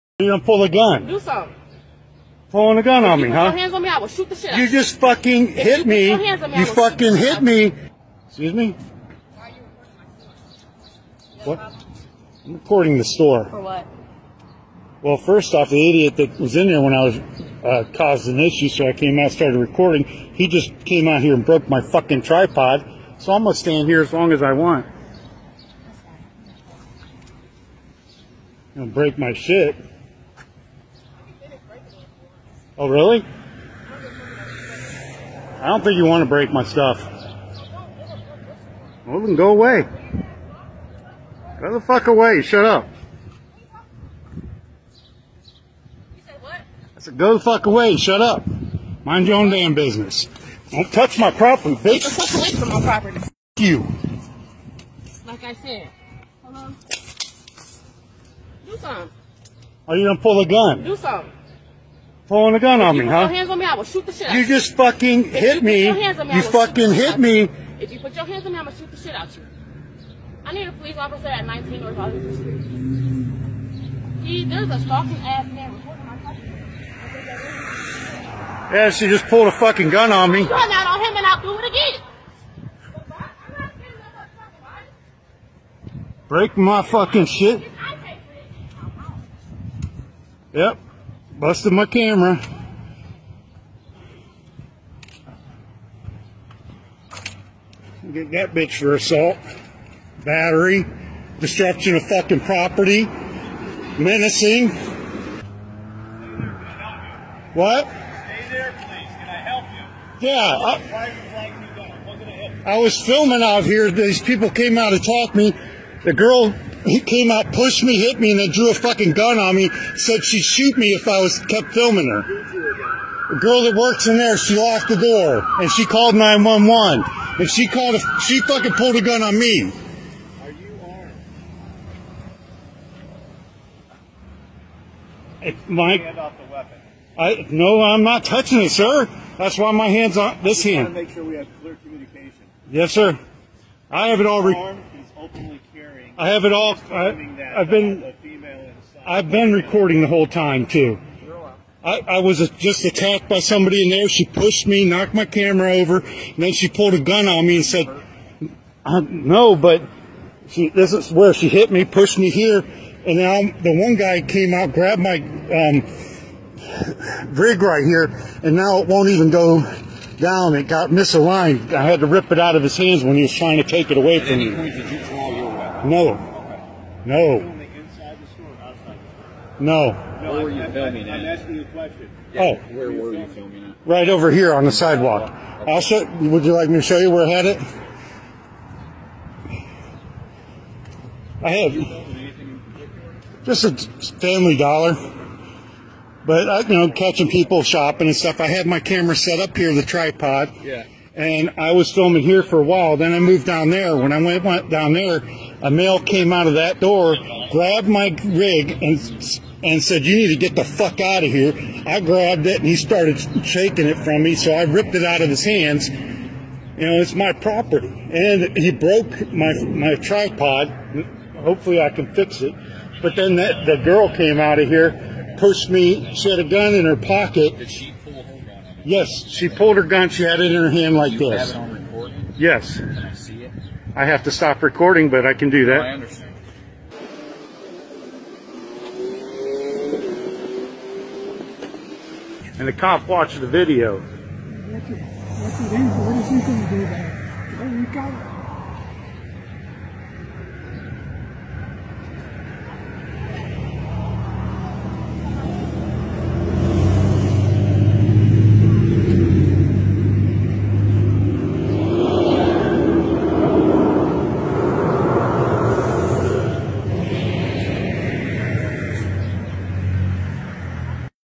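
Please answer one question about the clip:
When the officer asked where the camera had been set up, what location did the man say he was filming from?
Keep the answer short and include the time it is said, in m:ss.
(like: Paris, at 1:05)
the sidewalk, at 3:04.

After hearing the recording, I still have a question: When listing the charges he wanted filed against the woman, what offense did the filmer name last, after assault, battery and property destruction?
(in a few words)
menacing.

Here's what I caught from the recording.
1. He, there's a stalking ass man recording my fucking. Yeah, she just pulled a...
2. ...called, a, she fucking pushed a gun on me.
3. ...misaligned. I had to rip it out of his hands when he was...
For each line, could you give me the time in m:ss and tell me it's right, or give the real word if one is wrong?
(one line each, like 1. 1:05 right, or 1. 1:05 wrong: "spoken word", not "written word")
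1. 1:14 right
2. 2:07 wrong: "pulled", not "pushed"
3. 2:50 right.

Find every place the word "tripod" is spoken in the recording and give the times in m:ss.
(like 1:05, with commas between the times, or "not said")
0:22, 3:19, 3:39.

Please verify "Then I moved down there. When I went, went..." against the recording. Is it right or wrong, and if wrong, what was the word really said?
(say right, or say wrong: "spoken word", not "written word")
right.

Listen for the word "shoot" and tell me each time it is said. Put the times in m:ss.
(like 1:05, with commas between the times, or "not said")
0:04, 1:03, 1:08, 2:00.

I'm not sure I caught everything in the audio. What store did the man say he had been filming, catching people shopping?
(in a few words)
Family Dollar.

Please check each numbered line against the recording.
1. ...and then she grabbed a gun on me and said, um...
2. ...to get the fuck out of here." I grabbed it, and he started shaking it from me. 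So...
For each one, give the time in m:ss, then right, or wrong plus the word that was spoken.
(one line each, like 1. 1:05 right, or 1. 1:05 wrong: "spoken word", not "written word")
1. 2:36 wrong: "pulled", not "grabbed"
2. 3:30 right.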